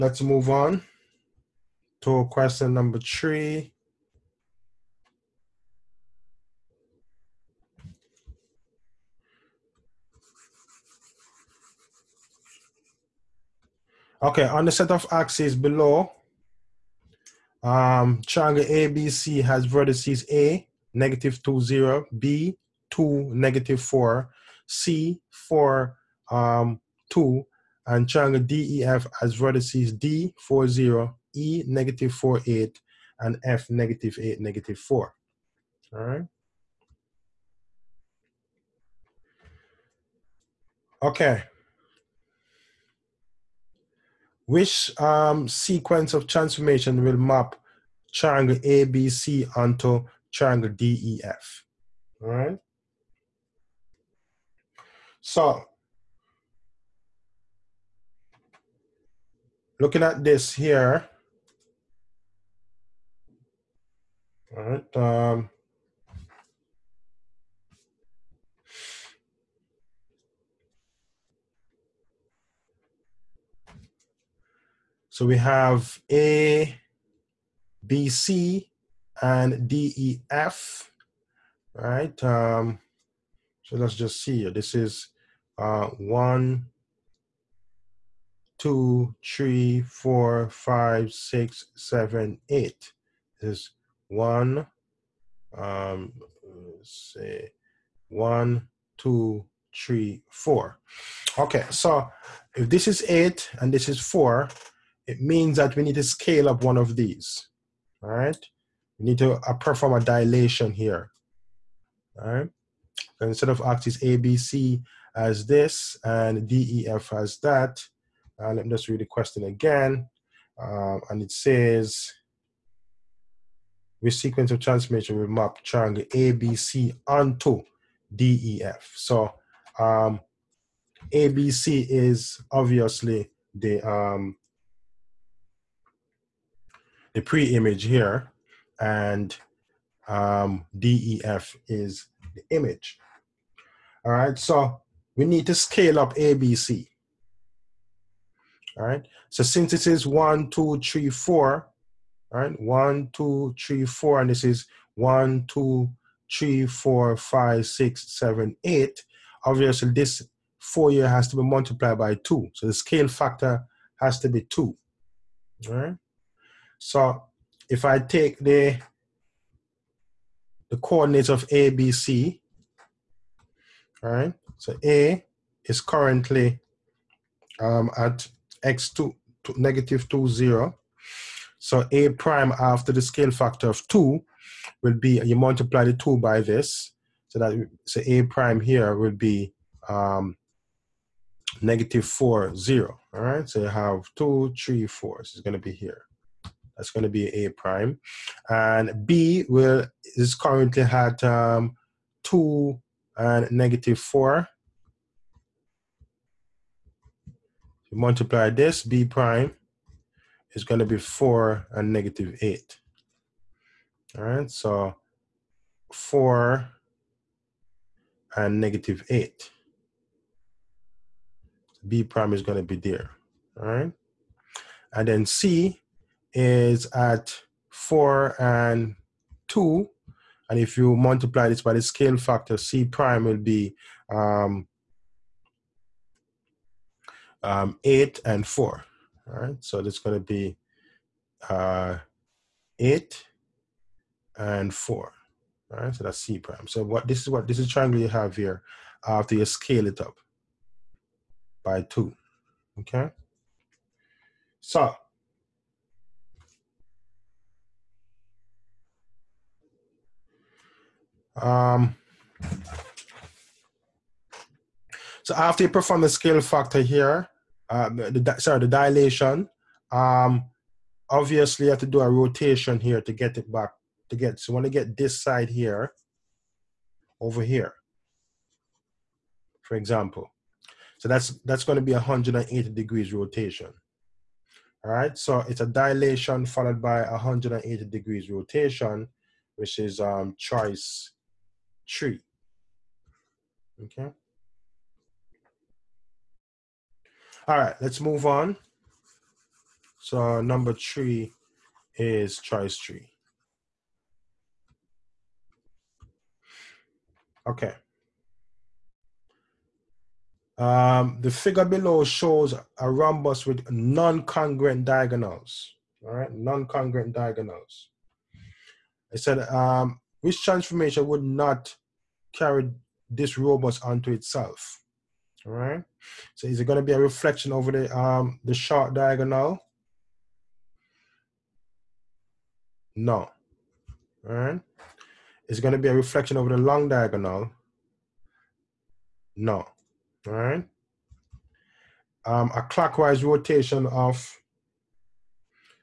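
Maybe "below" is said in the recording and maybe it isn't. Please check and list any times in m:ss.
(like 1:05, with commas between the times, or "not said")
0:15, 5:11.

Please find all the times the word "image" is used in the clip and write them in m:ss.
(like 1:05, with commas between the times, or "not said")
2:17, 2:22.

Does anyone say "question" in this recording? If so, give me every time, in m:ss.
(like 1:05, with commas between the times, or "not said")
0:02, 1:59.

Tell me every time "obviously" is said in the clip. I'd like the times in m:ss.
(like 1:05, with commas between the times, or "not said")
2:12, 2:39, 4:31.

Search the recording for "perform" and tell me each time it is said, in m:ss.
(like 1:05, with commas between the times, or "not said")
1:49, 4:25.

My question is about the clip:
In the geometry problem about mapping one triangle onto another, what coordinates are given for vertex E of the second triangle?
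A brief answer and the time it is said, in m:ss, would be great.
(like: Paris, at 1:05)
(-4, 8), at 0:31.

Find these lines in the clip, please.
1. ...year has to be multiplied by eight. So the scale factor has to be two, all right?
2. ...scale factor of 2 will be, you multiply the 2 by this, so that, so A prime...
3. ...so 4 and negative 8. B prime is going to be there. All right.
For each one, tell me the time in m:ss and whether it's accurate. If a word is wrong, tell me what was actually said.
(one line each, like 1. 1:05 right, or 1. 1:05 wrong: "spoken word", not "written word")
1. 2:40 wrong: "two", not "eight"
2. 3:03 right
3. 3:34 right.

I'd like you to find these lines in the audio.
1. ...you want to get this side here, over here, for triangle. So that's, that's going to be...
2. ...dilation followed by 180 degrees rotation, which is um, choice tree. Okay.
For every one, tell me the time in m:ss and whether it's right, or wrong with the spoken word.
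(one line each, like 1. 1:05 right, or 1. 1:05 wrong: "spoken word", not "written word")
1. 4:34 wrong: "example", not "triangle"
2. 4:45 right.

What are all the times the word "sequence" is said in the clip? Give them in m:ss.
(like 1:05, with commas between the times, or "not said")
0:45, 2:04.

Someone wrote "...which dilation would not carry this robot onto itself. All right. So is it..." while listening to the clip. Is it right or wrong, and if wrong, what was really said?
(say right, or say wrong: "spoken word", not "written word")
wrong: "transformation", not "dilation".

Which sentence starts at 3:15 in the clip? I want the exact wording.
So it's going to be here.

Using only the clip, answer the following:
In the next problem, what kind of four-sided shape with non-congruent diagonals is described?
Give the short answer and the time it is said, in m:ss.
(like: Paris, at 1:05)
Rhombus, at 5:12.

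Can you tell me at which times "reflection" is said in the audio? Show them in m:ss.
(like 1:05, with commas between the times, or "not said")
5:26, 5:35.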